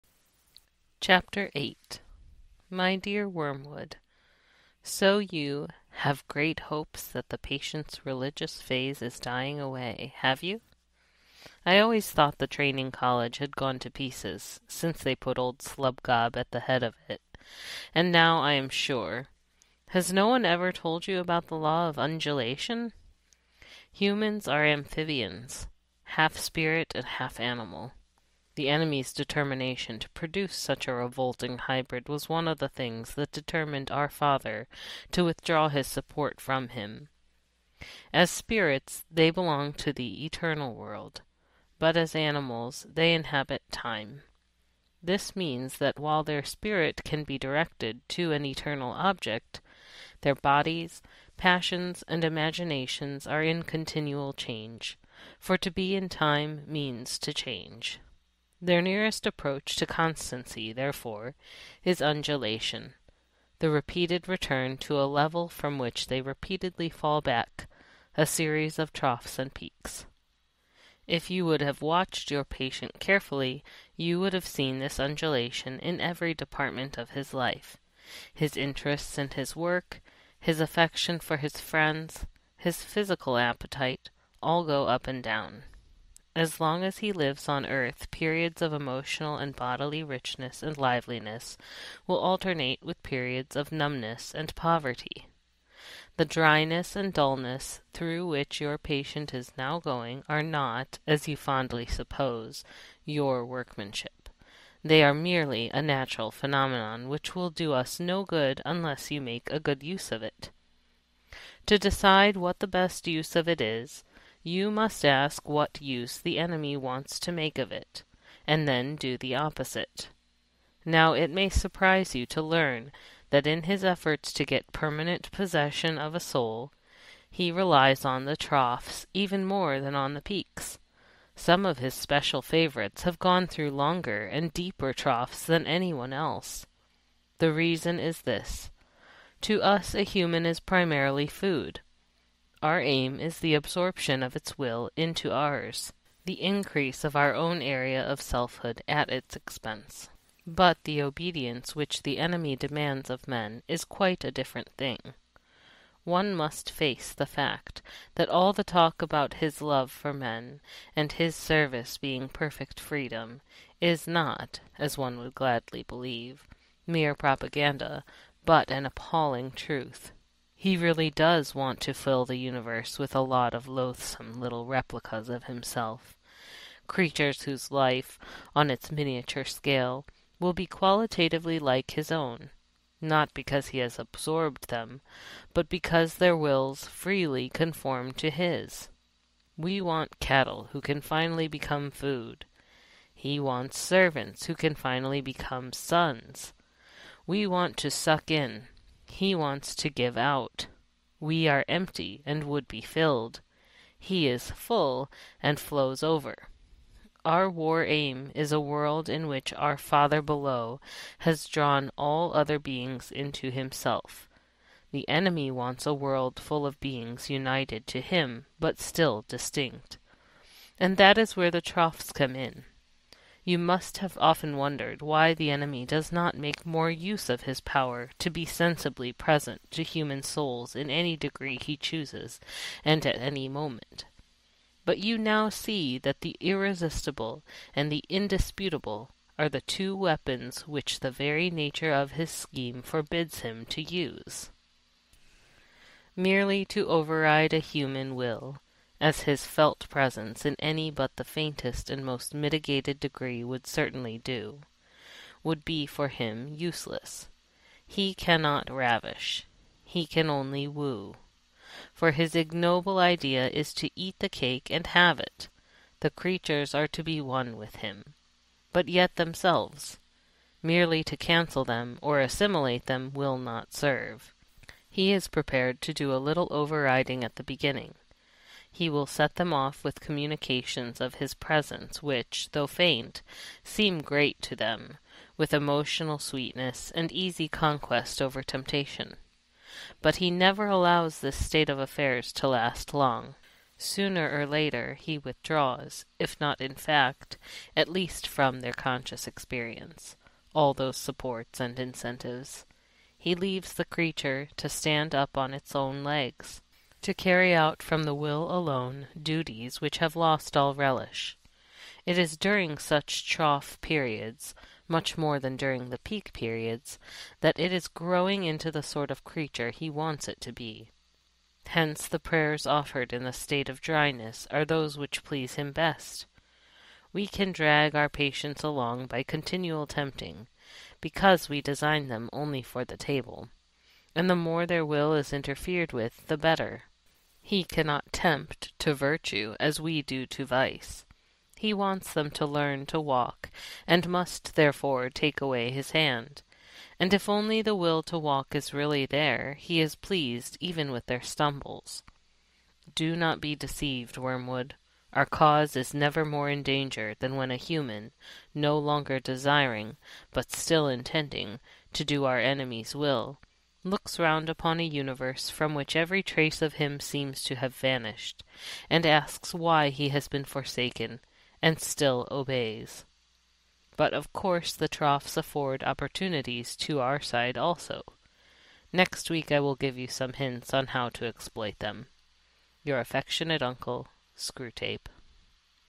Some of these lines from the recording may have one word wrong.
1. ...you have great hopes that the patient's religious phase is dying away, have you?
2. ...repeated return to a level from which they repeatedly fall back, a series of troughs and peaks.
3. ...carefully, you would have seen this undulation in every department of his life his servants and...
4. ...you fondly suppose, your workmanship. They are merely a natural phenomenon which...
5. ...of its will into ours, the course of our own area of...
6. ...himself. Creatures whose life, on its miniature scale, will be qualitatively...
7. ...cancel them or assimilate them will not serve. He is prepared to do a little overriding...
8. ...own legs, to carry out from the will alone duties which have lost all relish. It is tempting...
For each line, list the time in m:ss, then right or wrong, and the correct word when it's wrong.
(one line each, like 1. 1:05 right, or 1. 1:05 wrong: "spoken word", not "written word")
1. 0:05 right
2. 1:03 right
3. 1:12 wrong: "interests", not "servants"
4. 1:41 right
5. 2:24 wrong: "increase", not "course"
6. 2:55 right
7. 4:31 right
8. 5:05 wrong: "during", not "tempting".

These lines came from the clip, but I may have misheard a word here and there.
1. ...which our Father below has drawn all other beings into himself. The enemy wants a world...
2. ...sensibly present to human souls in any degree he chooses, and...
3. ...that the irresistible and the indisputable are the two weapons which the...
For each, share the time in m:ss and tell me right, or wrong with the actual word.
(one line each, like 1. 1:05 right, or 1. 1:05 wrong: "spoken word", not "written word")
1. 3:29 right
2. 3:48 right
3. 3:55 right.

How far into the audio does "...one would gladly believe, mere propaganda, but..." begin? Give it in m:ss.
2:44.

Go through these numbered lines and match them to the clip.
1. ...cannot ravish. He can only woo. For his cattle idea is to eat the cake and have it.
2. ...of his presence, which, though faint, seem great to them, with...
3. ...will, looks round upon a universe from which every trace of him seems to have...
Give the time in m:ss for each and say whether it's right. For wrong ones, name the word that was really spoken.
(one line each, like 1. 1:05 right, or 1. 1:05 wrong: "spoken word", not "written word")
1. 4:18 wrong: "ignoble", not "cattle"
2. 4:41 right
3. 6:02 right.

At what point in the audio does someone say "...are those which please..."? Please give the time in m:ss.
5:24.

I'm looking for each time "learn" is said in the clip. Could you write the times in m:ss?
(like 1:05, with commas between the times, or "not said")
2:02, 5:42.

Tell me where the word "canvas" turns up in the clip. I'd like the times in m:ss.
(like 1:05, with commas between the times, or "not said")
not said.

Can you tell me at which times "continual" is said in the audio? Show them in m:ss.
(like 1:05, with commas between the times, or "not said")
0:53, 5:29.